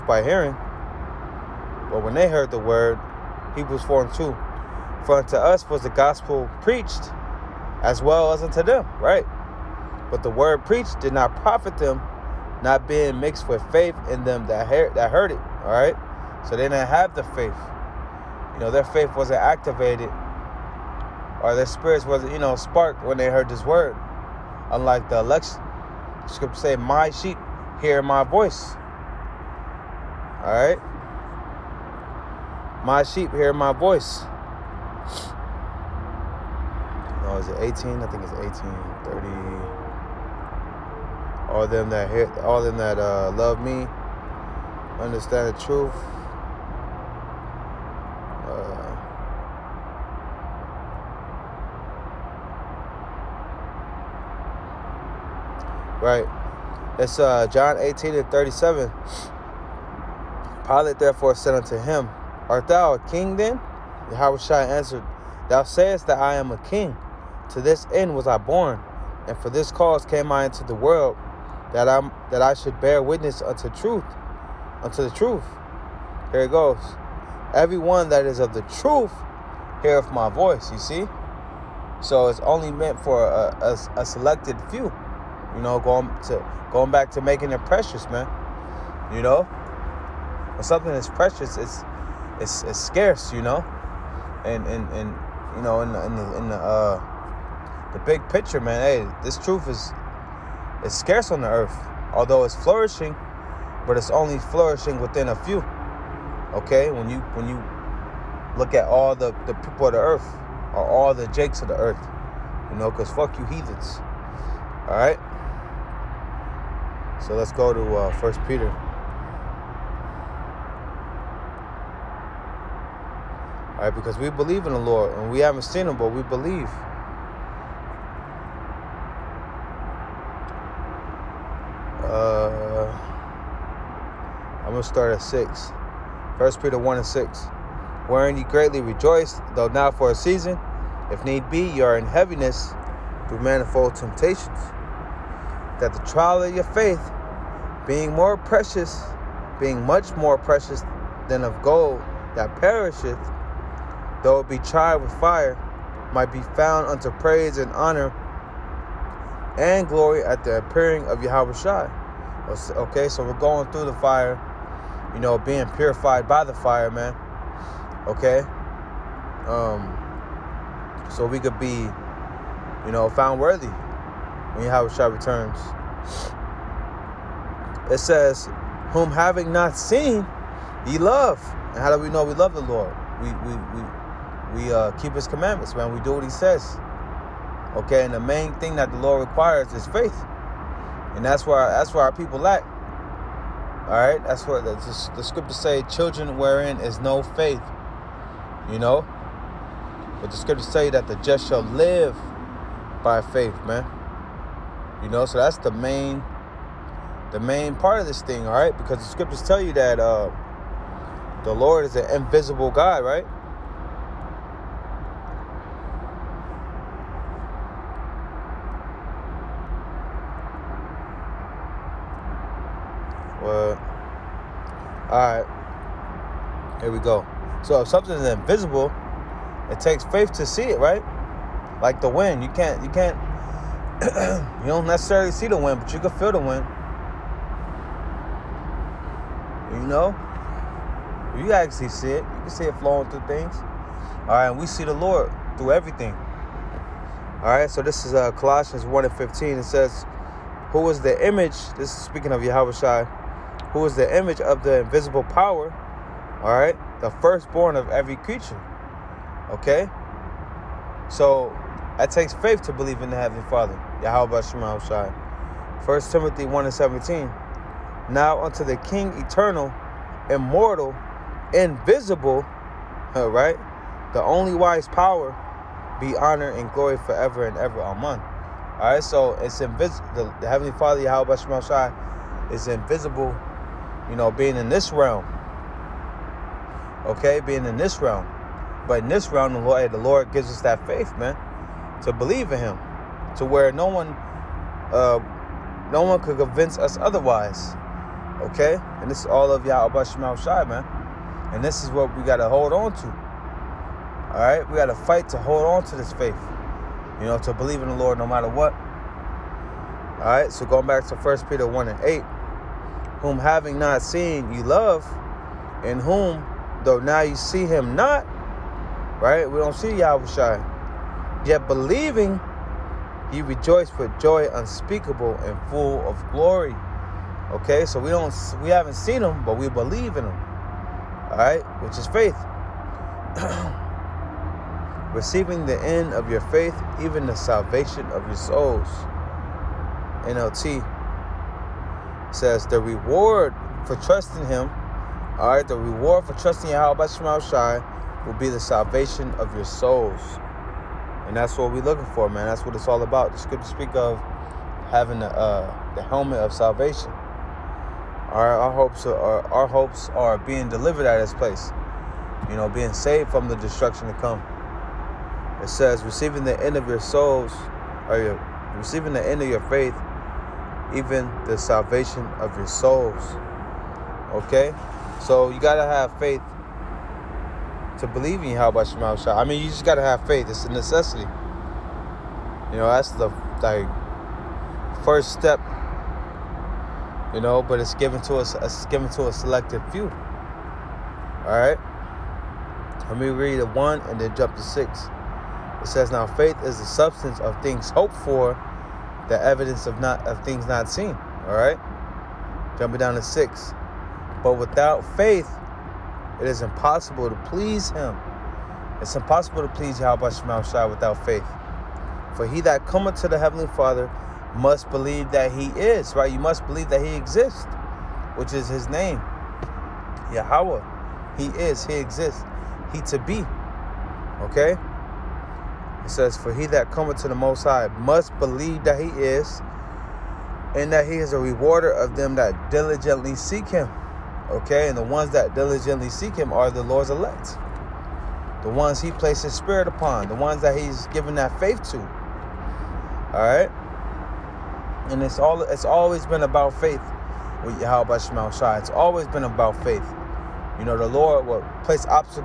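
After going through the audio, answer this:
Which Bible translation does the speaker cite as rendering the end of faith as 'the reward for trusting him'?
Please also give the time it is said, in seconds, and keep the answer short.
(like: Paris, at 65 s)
NLT, at 340 s.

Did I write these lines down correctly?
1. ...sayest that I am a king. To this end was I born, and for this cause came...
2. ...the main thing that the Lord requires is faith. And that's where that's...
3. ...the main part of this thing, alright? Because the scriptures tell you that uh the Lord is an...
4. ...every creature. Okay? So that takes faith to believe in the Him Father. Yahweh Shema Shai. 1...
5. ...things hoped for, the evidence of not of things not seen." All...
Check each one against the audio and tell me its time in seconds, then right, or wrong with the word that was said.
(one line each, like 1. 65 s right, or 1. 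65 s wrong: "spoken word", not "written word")
1. 65 s right
2. 188 s right
3. 207 s right
4. 257 s wrong: "Heavenly", not "Him"
5. 397 s right.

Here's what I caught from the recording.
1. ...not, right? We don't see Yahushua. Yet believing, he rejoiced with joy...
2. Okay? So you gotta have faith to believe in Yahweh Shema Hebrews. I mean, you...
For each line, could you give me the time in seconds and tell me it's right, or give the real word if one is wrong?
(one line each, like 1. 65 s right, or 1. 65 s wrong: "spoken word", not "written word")
1. 317 s right
2. 374 s wrong: "Shah", not "Hebrews".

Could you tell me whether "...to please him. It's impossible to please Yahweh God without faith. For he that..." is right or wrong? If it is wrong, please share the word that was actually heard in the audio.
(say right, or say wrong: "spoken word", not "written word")
wrong: "Shema", not "God".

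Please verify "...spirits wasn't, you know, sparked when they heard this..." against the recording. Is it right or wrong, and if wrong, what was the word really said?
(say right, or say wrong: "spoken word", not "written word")
right.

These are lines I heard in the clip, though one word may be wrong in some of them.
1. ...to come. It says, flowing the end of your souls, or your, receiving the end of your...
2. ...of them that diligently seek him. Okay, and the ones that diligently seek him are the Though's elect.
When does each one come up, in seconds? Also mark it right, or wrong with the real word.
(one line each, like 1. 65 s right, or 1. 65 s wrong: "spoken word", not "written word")
1. 364 s wrong: "receiving", not "flowing"
2. 431 s wrong: "Lord", not "Though".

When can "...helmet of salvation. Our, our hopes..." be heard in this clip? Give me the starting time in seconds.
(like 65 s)
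356 s.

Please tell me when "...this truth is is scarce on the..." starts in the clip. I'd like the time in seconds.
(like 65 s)
99 s.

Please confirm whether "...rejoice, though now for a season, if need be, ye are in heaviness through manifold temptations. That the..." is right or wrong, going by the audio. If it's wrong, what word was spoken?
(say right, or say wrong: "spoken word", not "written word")
right.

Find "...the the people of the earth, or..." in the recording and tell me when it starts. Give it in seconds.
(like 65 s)
109 s.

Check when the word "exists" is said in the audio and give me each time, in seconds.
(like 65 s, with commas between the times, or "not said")
417 s, 421 s.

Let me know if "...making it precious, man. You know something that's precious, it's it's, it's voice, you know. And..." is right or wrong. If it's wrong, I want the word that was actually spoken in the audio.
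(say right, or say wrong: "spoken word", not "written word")
wrong: "scarce", not "voice".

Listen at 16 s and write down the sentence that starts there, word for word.
So they didn't have the faith.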